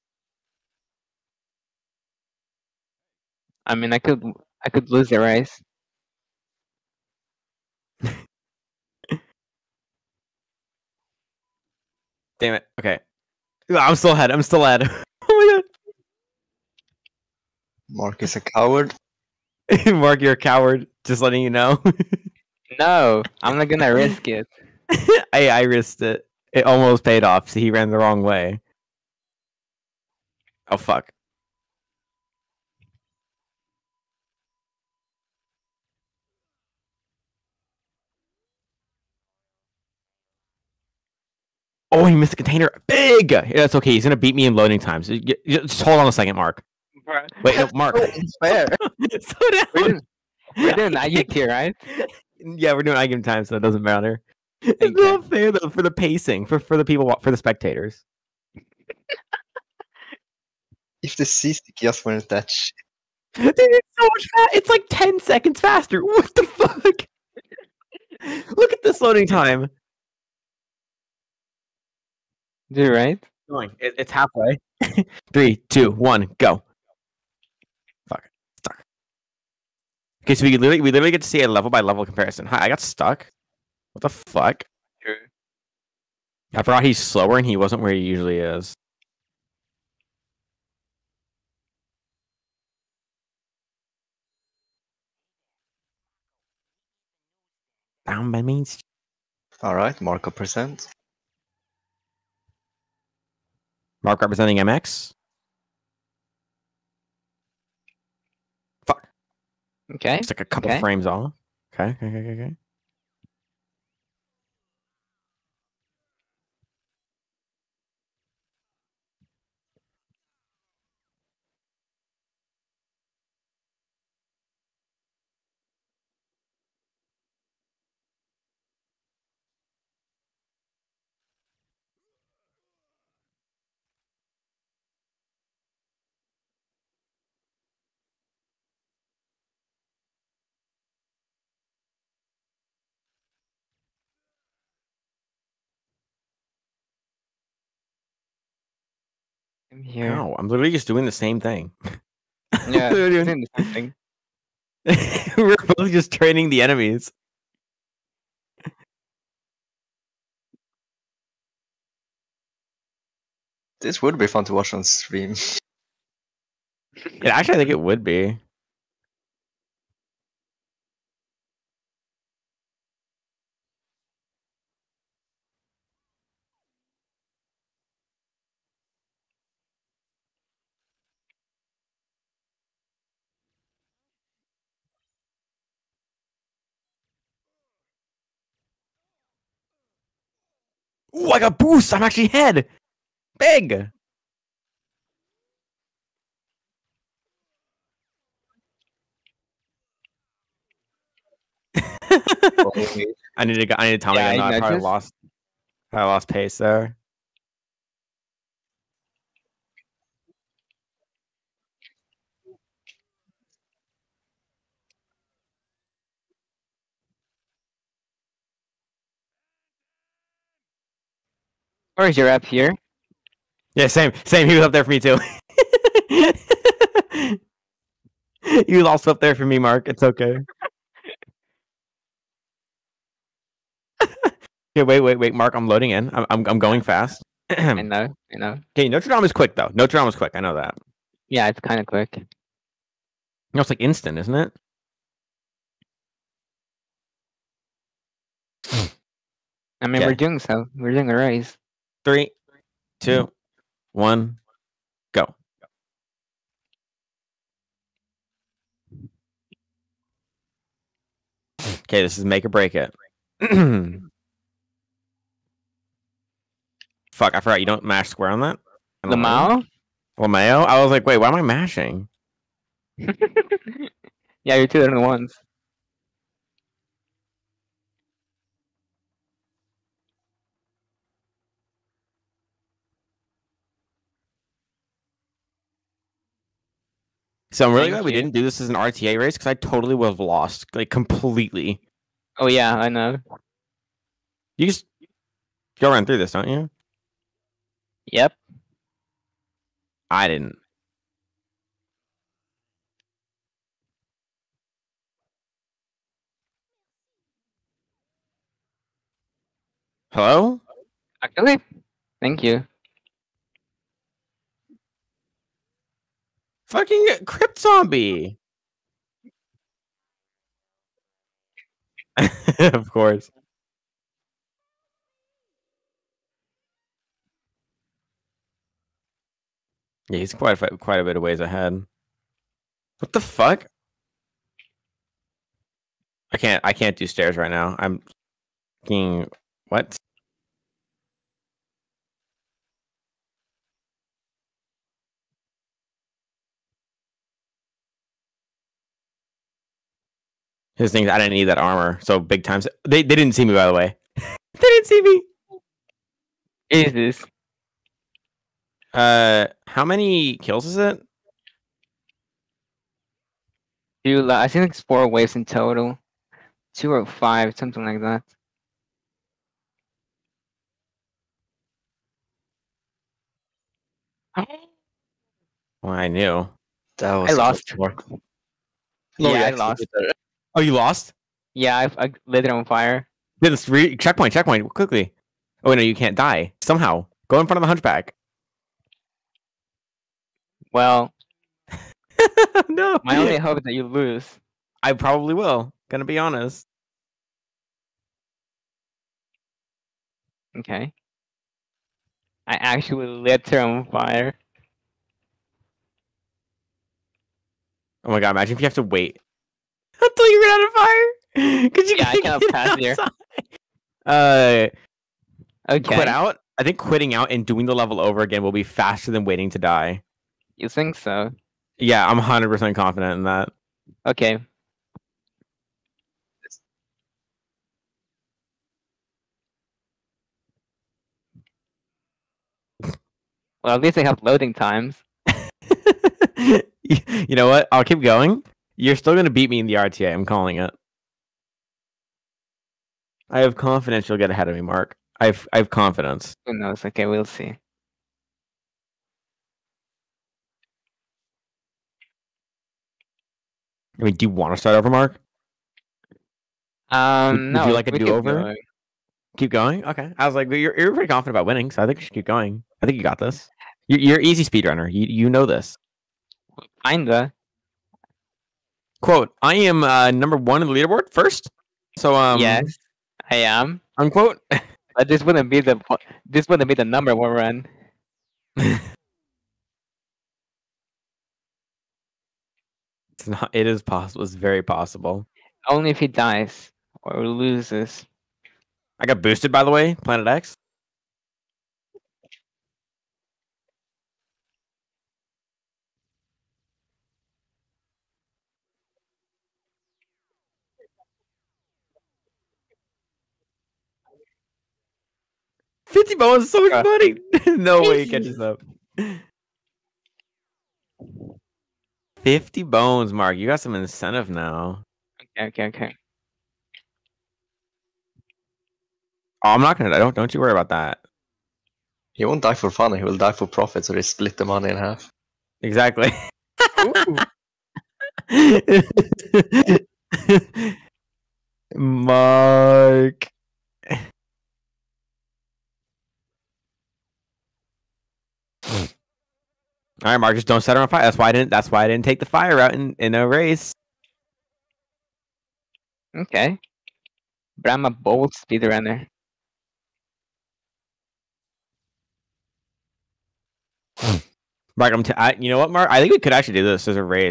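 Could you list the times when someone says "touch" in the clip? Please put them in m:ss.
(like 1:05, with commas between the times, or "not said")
1:02.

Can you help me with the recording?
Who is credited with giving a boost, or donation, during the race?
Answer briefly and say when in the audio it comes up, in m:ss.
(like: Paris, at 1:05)
Planet X, at 8:10.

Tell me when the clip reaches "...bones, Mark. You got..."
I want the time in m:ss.
8:32.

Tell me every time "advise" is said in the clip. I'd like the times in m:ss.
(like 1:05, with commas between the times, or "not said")
not said.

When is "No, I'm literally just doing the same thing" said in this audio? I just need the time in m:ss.
2:30.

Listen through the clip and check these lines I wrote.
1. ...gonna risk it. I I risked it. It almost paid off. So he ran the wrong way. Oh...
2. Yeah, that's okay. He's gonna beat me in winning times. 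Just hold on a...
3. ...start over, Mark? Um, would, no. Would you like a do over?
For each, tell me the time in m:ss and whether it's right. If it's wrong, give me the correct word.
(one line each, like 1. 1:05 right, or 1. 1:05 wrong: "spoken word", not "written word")
1. 0:23 right
2. 0:43 wrong: "loading", not "winning"
3. 7:34 right.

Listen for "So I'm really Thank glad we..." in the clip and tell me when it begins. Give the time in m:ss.
4:47.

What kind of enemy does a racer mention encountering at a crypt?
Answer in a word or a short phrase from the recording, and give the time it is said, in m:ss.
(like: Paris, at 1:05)
Zombie, at 5:17.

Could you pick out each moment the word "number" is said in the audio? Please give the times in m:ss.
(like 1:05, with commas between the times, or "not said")
7:50, 7:56.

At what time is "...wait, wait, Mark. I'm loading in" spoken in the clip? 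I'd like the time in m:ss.
3:55.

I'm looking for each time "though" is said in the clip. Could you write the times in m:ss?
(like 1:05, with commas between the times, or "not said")
0:55, 3:59.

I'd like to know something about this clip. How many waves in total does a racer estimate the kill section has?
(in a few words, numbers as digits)
4.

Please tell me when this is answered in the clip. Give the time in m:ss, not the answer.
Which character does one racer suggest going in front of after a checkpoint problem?
6:27.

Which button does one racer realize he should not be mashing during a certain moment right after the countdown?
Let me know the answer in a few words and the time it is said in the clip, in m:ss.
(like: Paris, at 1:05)
Square, at 4:28.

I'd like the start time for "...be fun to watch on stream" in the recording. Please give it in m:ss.
2:44.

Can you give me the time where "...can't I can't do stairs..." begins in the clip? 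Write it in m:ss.
5:36.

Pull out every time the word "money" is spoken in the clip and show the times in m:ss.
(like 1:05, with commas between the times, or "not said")
8:26, 8:44.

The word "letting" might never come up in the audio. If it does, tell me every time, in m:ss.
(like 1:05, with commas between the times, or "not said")
0:21.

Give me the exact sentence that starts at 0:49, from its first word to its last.
We're, doing, we're doing IGT, here, right?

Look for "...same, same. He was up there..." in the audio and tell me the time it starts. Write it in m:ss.
3:43.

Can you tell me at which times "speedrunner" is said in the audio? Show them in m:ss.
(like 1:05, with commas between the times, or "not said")
7:44, 9:08.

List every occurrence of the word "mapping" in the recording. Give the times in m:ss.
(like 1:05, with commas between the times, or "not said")
not said.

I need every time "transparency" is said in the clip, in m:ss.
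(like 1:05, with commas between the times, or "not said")
not said.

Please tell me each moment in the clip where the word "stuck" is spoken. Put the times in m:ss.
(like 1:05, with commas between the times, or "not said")
1:18, 1:22.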